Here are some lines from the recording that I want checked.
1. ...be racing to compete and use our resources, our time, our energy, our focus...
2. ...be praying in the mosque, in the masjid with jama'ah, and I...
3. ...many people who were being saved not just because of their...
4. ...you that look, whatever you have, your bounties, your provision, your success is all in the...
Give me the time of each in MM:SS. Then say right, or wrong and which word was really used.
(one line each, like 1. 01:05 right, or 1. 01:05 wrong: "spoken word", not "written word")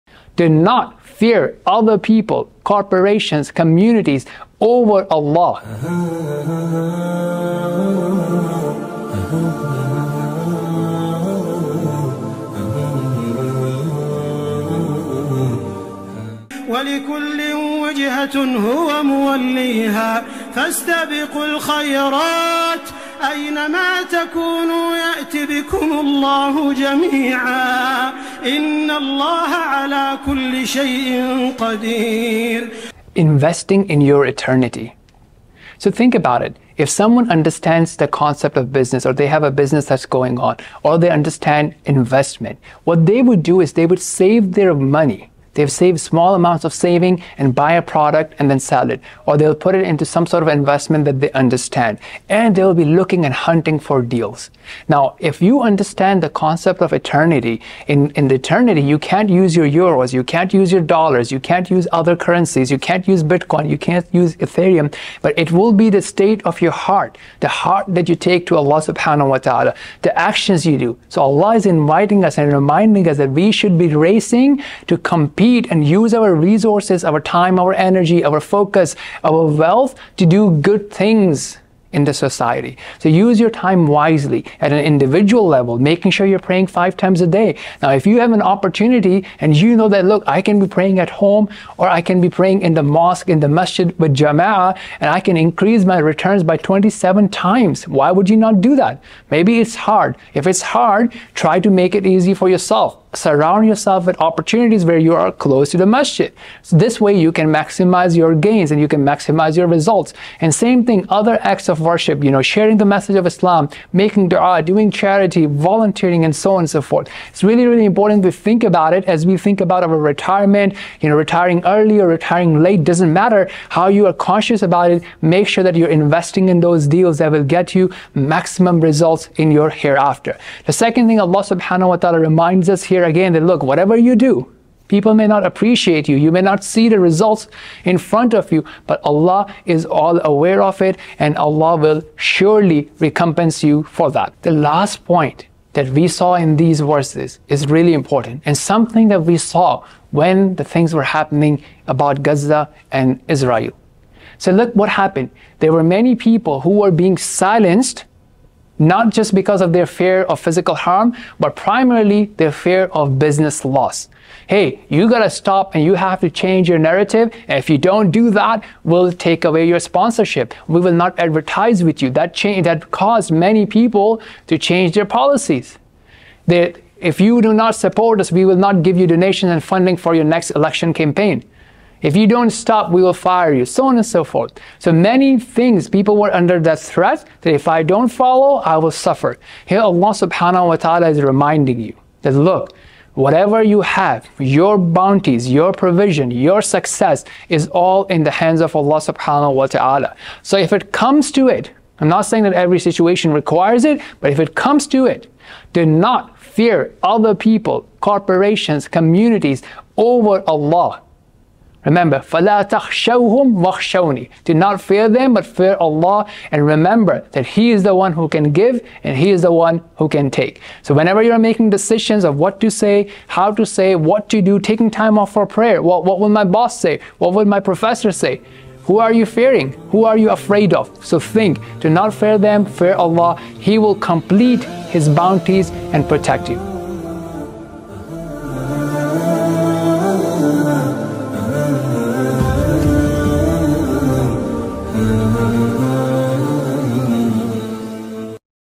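1. 01:13 right
2. 01:32 right
3. 02:35 wrong: "silenced", not "saved"
4. 03:11 right.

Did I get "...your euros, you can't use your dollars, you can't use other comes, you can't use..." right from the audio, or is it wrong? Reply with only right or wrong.
wrong.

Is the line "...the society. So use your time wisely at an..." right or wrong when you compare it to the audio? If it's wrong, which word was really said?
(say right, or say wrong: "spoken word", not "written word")
right.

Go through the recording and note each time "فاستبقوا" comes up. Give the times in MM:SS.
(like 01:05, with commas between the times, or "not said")
00:20.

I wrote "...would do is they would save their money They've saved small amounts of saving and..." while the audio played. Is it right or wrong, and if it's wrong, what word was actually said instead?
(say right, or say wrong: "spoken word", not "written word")
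right.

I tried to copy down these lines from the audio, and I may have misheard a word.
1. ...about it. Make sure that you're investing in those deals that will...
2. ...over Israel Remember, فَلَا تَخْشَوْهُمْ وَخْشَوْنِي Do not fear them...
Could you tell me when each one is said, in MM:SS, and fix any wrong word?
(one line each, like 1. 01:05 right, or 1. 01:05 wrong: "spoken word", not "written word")
1. 02:04 right
2. 03:29 wrong: "Allah", not "Israel".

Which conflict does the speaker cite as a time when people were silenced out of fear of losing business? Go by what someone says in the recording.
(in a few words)
Gaza and Israel.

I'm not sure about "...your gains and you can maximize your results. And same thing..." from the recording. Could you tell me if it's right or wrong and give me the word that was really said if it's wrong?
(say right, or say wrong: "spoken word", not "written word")
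right.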